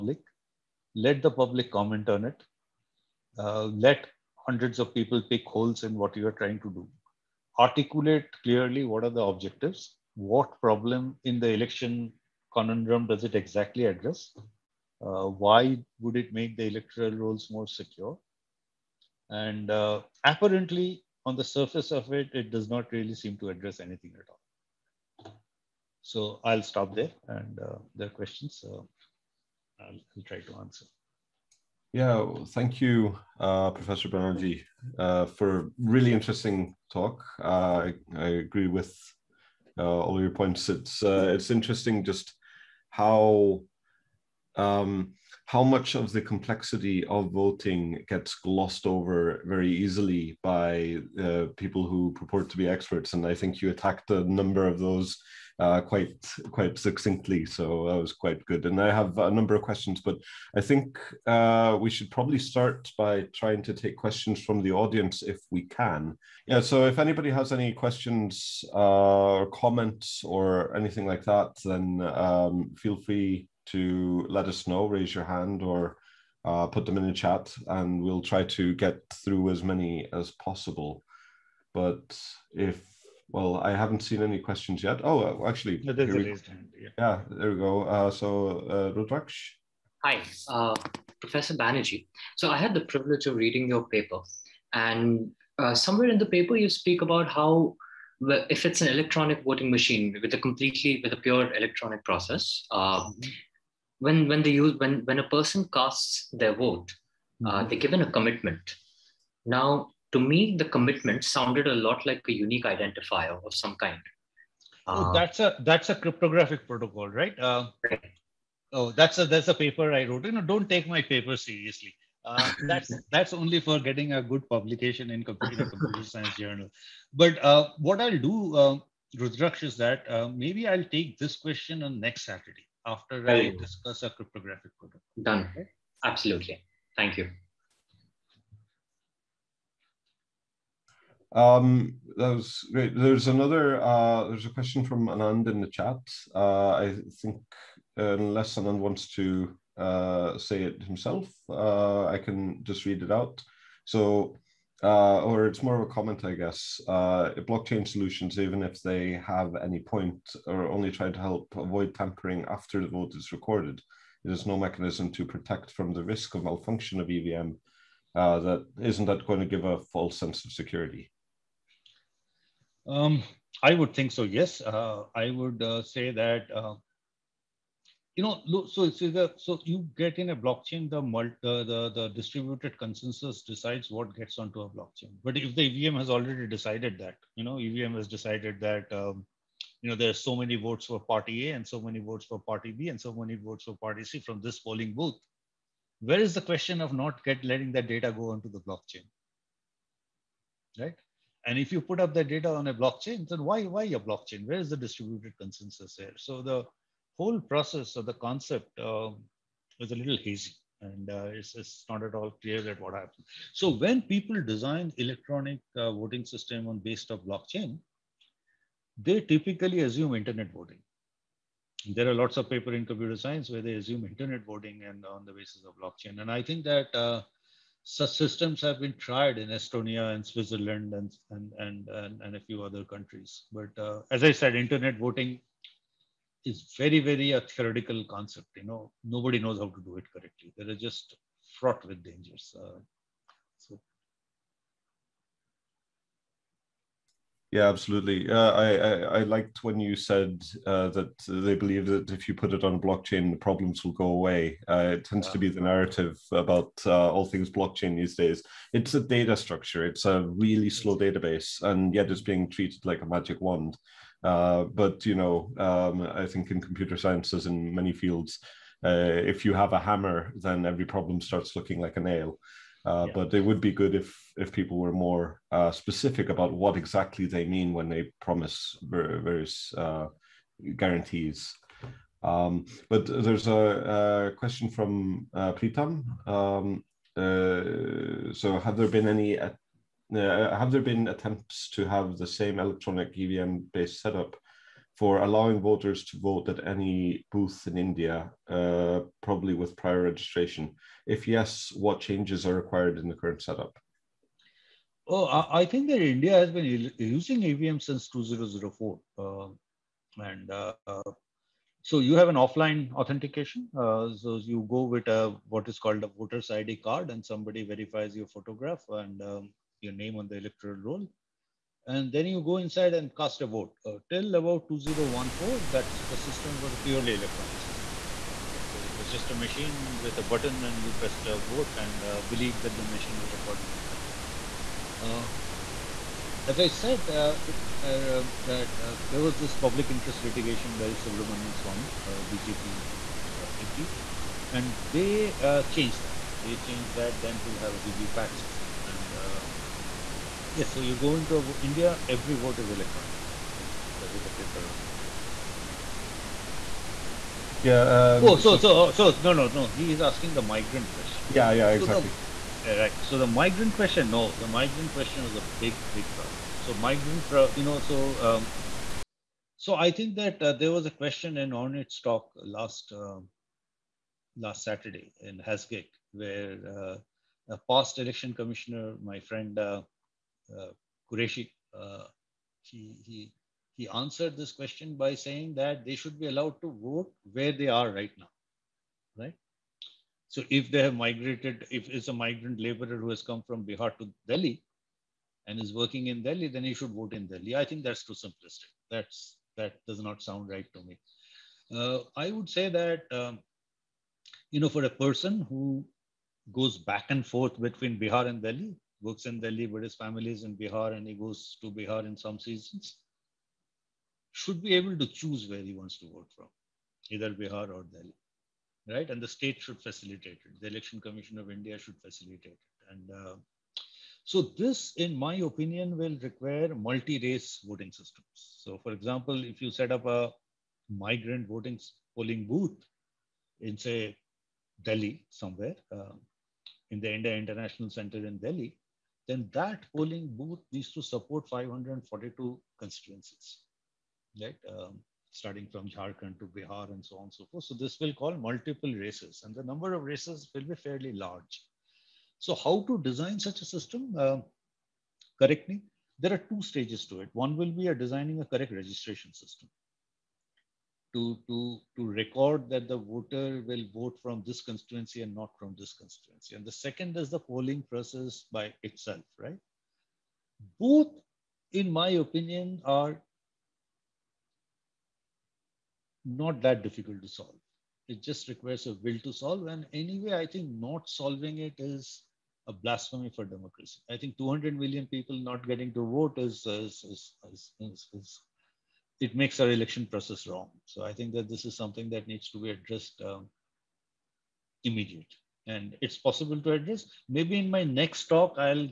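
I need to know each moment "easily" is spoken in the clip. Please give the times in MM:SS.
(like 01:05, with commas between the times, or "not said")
00:49.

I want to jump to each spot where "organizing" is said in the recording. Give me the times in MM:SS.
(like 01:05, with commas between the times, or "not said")
not said.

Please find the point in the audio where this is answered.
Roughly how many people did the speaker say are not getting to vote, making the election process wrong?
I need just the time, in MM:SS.
08:04.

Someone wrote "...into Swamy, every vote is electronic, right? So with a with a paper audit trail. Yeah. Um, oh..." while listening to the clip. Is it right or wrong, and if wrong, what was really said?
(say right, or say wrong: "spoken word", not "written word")
wrong: "India", not "Swamy".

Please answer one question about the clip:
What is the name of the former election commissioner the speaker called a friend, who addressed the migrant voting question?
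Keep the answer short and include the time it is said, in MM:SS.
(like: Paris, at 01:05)
Qureshi, at 06:21.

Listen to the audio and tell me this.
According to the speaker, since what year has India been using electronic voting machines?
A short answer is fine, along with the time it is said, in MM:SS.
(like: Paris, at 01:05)
2004, at 05:08.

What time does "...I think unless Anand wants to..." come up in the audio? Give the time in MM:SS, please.
02:26.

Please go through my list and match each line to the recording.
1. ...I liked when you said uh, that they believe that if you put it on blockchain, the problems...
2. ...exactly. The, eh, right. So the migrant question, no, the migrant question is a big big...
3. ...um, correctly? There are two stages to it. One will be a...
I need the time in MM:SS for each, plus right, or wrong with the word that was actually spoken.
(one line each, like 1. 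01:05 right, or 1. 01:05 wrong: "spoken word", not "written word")
1. 04:09 right
2. 06:01 right
3. 07:34 right.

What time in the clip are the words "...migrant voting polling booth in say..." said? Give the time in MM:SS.
07:10.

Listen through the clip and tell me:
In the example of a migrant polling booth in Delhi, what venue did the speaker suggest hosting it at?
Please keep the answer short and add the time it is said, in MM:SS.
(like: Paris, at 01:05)
India International Center, at 07:17.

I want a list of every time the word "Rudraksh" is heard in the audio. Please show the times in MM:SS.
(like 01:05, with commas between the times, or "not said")
01:28, 02:09.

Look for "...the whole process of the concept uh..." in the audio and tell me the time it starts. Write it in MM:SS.
03:26.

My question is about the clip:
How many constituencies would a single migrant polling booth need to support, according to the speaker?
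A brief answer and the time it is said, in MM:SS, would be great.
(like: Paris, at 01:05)
542, at 07:21.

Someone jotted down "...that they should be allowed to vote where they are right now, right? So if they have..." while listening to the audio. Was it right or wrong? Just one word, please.
right.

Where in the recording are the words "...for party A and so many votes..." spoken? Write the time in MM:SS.
03:10.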